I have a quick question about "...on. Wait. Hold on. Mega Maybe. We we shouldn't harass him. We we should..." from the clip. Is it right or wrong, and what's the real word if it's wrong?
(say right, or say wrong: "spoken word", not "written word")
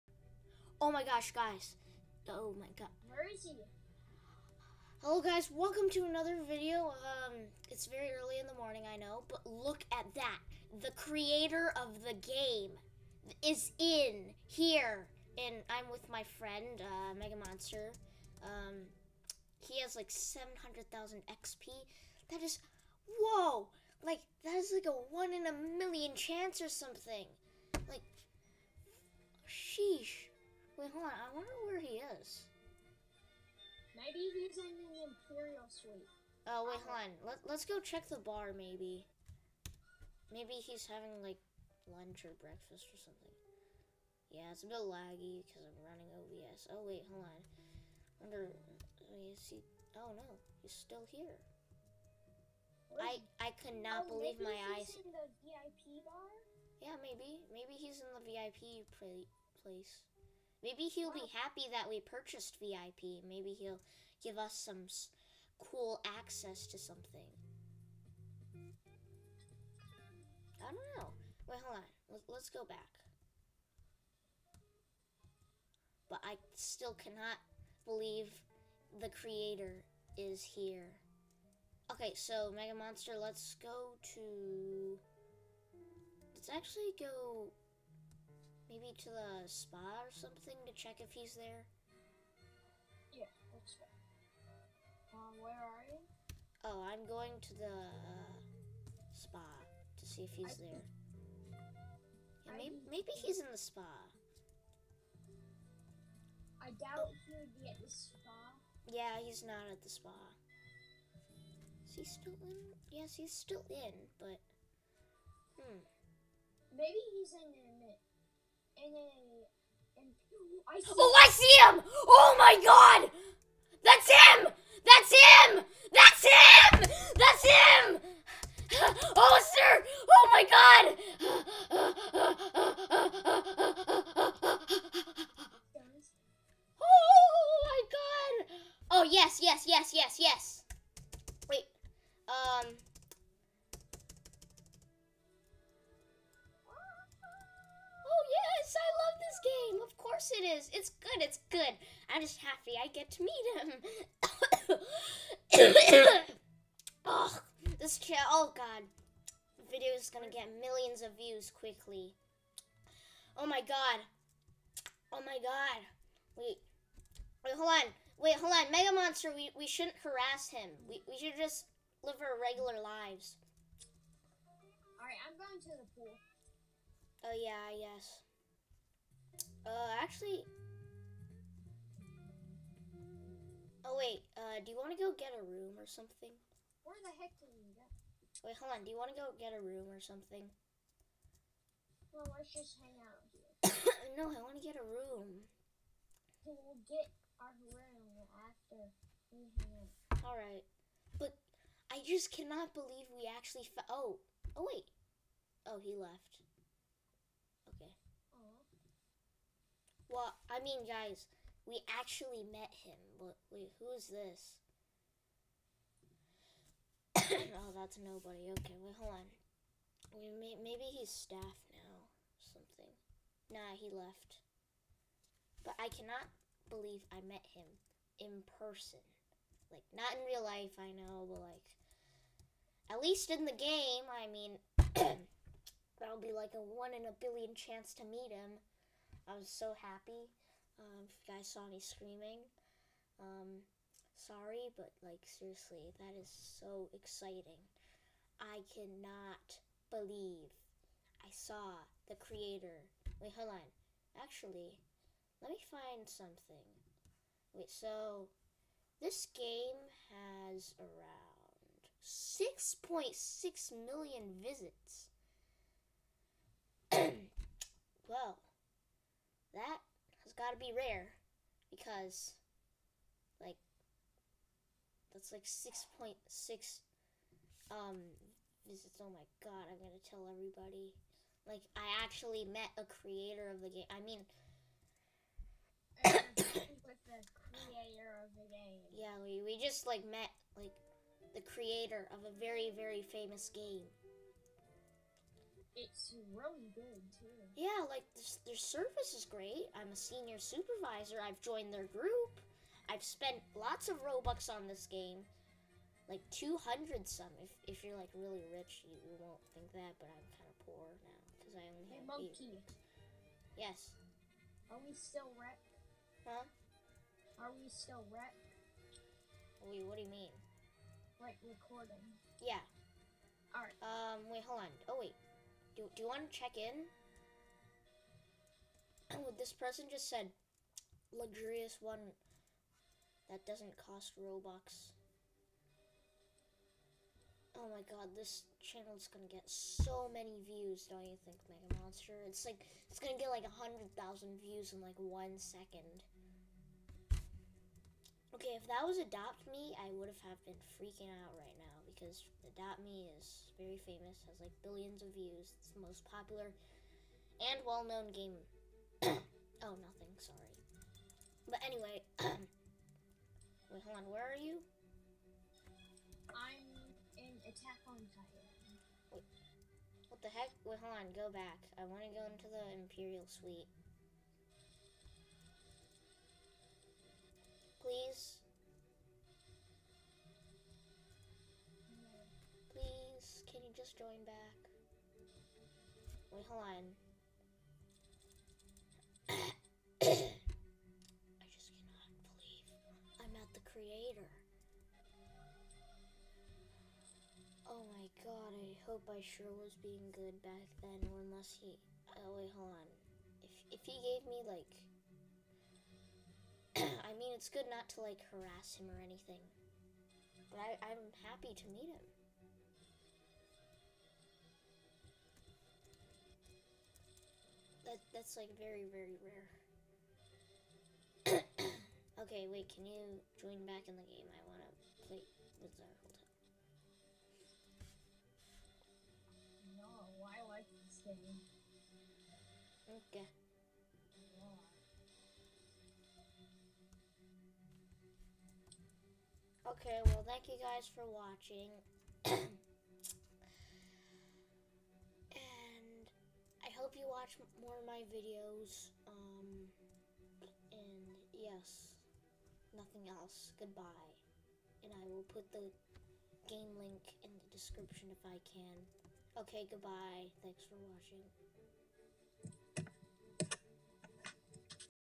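wrong: "Monster", not "Maybe".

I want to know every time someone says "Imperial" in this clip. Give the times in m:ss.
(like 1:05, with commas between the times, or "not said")
0:35, 6:12.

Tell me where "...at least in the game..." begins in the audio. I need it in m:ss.
3:52.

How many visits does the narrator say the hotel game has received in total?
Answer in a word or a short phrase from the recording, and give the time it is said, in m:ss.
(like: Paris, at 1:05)
6.6 million, at 4:22.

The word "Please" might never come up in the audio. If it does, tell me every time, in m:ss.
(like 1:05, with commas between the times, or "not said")
6:17, 6:22.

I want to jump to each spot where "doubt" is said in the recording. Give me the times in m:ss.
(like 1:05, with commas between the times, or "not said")
1:46.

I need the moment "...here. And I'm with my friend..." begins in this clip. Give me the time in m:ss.
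0:14.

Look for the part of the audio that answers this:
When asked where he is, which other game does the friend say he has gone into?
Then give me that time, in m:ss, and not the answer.
6:07.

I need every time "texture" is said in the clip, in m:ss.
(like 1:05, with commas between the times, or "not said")
not said.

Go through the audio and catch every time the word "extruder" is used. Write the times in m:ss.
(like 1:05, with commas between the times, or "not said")
not said.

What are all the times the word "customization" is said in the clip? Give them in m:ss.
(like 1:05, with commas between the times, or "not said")
not said.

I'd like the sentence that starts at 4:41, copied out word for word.
Like, I actually met a creator of the game.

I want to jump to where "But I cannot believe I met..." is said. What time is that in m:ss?
3:45.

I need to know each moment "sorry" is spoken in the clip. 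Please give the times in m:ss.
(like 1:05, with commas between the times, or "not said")
4:04, 6:00.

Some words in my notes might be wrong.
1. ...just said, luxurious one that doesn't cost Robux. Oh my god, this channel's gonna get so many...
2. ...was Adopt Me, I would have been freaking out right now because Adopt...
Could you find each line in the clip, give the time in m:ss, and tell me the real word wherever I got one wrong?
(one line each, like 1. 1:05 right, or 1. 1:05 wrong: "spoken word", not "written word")
1. 5:29 right
2. 5:48 right.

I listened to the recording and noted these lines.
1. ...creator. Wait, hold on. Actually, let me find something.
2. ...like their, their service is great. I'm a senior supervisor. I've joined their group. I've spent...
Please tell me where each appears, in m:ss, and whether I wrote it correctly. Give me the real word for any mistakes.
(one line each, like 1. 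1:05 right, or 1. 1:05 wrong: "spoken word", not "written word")
1. 4:12 right
2. 4:57 right.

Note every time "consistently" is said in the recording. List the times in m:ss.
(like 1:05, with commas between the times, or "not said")
not said.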